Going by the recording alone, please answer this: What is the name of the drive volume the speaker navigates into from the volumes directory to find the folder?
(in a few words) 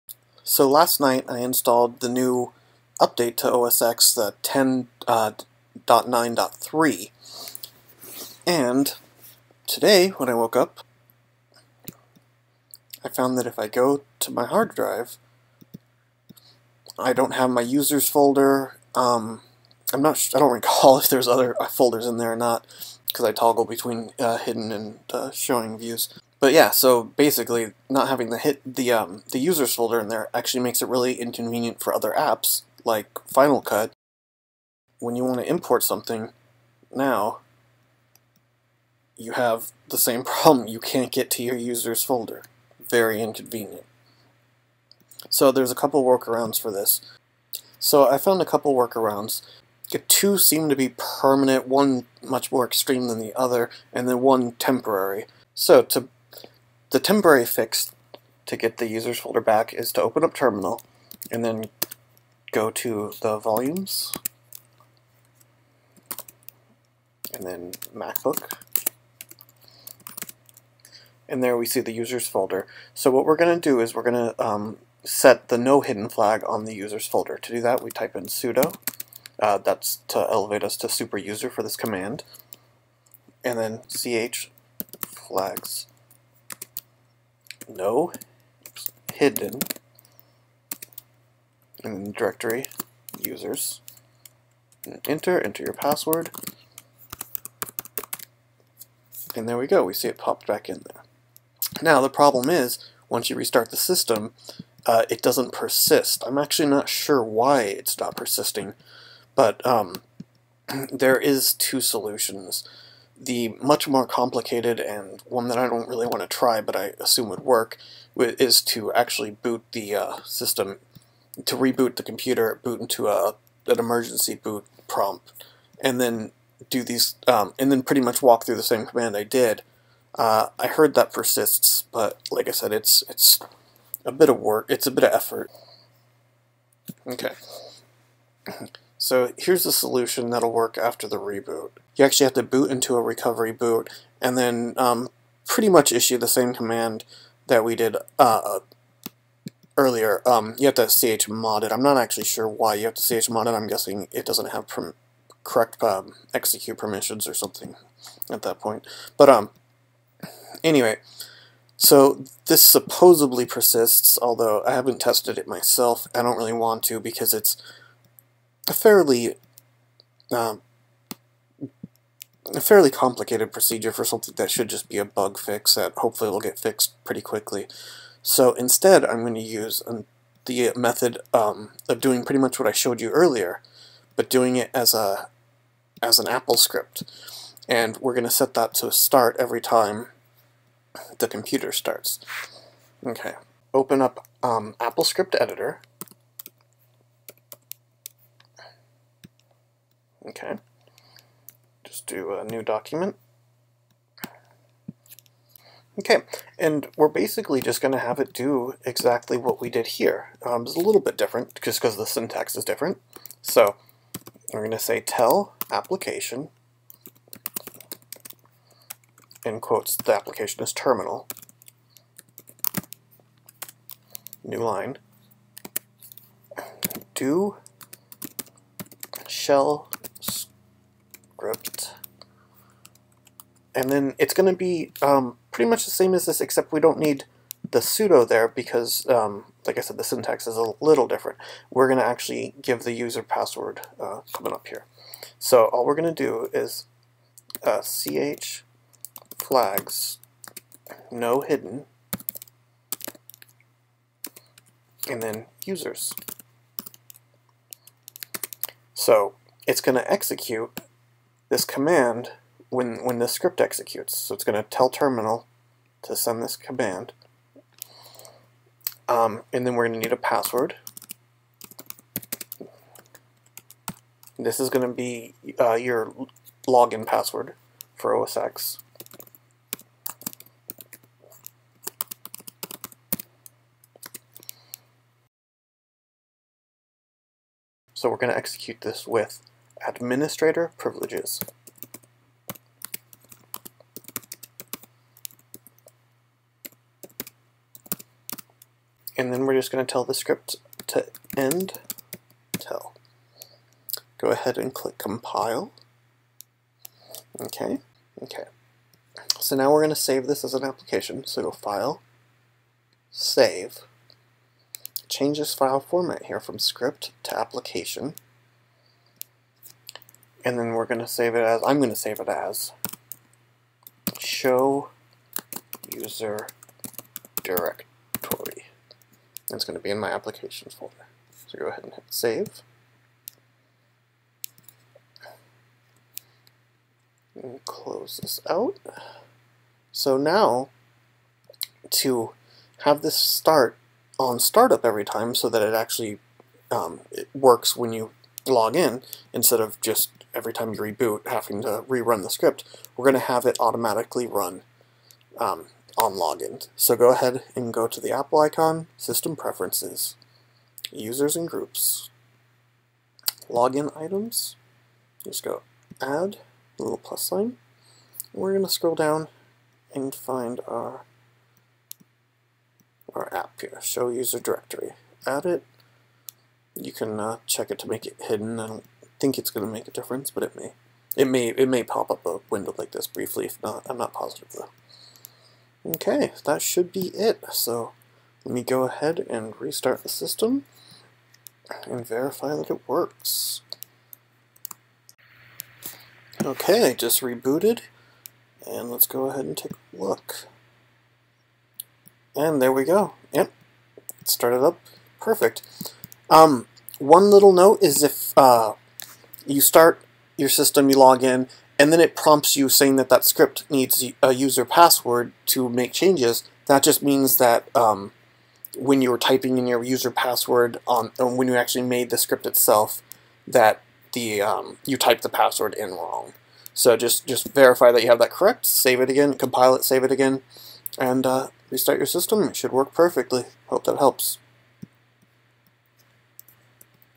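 MacBook.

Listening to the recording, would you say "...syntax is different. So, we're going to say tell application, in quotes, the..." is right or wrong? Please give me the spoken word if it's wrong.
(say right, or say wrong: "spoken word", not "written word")
right.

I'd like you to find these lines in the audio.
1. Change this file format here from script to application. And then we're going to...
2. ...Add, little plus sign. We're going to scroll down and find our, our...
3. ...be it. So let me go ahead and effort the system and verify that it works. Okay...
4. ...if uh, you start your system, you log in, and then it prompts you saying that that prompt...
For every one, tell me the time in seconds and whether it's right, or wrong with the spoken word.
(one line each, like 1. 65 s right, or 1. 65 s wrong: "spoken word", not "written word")
1. 315 s right
2. 366 s right
3. 386 s wrong: "restart", not "effort"
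4. 408 s wrong: "script", not "prompt".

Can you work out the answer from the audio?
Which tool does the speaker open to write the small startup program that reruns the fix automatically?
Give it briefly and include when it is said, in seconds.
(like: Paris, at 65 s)
AppleScript Editor, at 194 s.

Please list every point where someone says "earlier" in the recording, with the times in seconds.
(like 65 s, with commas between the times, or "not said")
149 s, 183 s.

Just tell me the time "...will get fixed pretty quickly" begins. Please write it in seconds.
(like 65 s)
176 s.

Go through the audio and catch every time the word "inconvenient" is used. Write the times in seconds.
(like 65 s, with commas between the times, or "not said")
31 s, 43 s.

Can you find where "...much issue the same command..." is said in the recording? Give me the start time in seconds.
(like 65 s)
145 s.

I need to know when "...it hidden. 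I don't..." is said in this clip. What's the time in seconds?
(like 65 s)
378 s.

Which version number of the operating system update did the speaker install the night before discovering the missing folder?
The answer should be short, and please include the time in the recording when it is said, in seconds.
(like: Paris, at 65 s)
10.9.3, at 4 s.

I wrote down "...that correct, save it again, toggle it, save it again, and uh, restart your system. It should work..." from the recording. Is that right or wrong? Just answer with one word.
wrong.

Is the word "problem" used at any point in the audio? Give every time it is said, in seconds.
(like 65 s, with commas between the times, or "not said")
40 s, 102 s.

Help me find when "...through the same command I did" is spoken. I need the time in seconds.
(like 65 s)
128 s.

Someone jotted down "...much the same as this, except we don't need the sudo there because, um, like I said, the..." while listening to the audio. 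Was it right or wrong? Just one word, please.
right.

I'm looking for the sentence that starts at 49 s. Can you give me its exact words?
The two seem to be permanent, one much more extreme than the other, and then one temporary.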